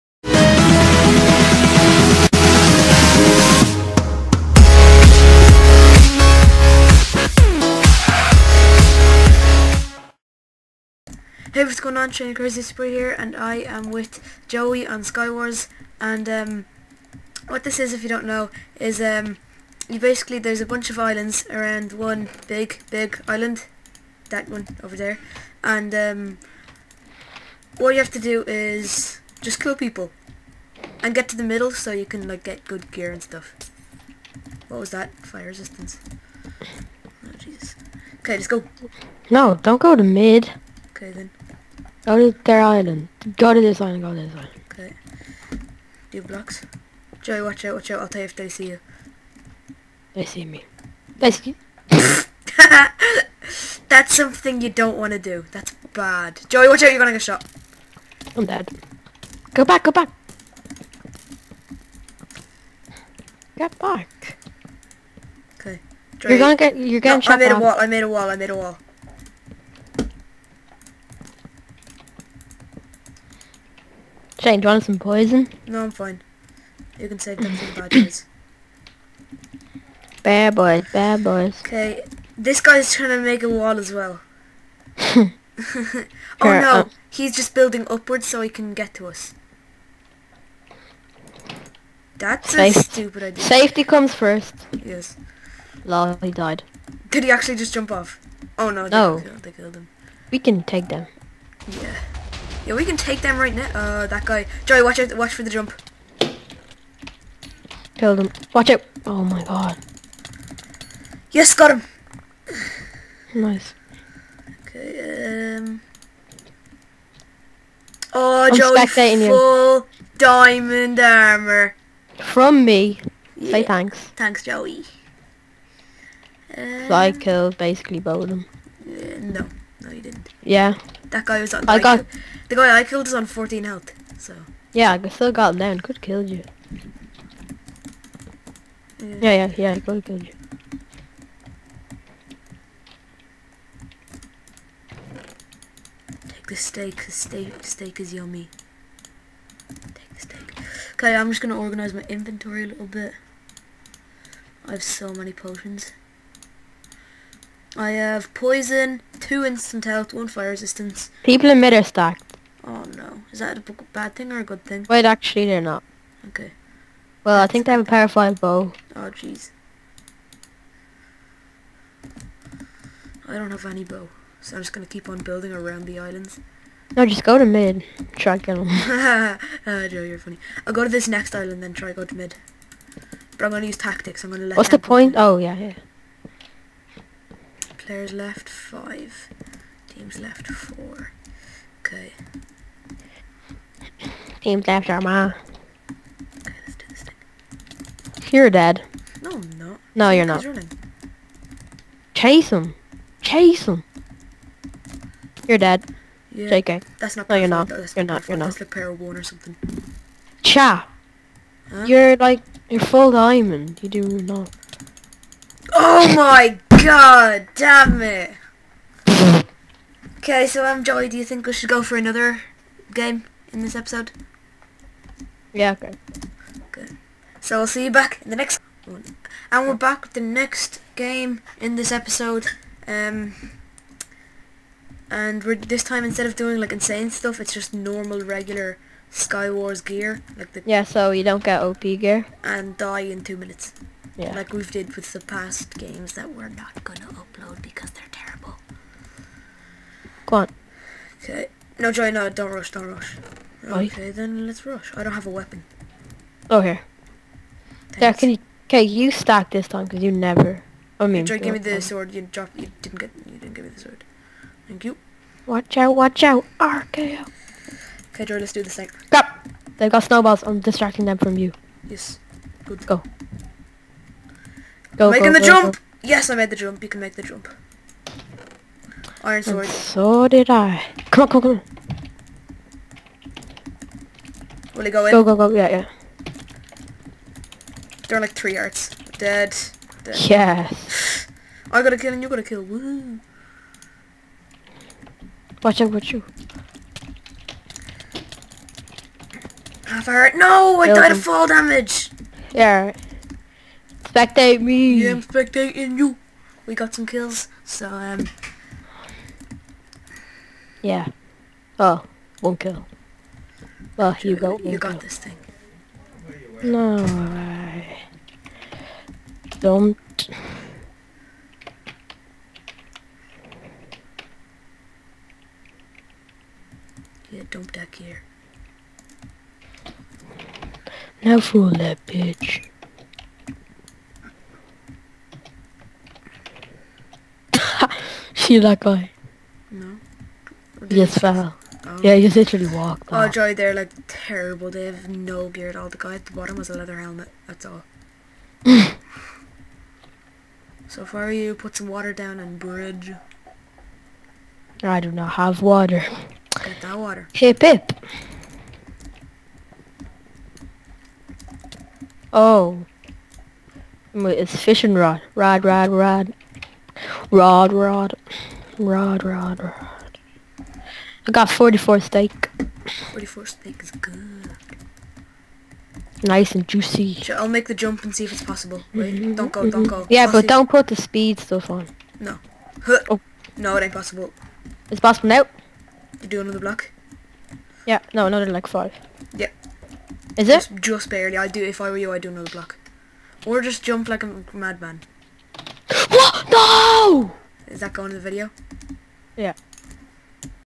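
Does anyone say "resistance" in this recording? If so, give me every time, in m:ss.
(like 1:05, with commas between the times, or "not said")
0:35, 2:40.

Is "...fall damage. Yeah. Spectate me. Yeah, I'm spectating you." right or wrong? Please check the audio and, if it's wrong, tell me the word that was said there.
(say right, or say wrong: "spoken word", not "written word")
right.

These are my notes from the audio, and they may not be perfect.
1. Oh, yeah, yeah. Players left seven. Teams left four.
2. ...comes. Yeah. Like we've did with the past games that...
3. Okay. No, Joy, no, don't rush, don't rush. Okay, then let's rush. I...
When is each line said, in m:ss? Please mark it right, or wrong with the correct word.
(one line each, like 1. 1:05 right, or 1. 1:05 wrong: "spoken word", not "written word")
1. 3:05 wrong: "five", not "seven"
2. 4:03 wrong: "minutes", not "comes"
3. 4:11 right.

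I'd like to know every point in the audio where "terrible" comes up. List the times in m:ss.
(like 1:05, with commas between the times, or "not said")
4:08, 5:44.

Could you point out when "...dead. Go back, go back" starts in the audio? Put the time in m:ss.
0:58.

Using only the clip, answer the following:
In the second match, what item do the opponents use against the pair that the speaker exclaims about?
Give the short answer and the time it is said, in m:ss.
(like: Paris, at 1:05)
Snowballs, at 4:30.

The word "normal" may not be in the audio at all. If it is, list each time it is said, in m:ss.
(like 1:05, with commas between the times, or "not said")
3:57.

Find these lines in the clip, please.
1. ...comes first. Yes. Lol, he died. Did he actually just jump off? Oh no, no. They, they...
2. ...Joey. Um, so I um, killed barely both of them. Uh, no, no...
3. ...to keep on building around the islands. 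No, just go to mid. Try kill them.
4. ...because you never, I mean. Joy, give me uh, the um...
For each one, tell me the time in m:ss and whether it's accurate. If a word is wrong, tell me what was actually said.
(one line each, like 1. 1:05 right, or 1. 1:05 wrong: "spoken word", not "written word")
1. 1:33 right
2. 2:04 wrong: "basically", not "barely"
3. 2:54 right
4. 4:19 right.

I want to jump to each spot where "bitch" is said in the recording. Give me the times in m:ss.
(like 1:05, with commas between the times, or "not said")
5:32.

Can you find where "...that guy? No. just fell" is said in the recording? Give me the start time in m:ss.
5:38.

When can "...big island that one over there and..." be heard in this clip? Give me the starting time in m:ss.
0:22.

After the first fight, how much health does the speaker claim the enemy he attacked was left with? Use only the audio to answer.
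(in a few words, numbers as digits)
14.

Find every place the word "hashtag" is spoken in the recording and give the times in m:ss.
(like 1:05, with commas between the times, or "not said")
not said.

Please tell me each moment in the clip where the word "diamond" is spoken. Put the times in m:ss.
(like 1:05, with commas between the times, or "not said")
2:00, 3:33.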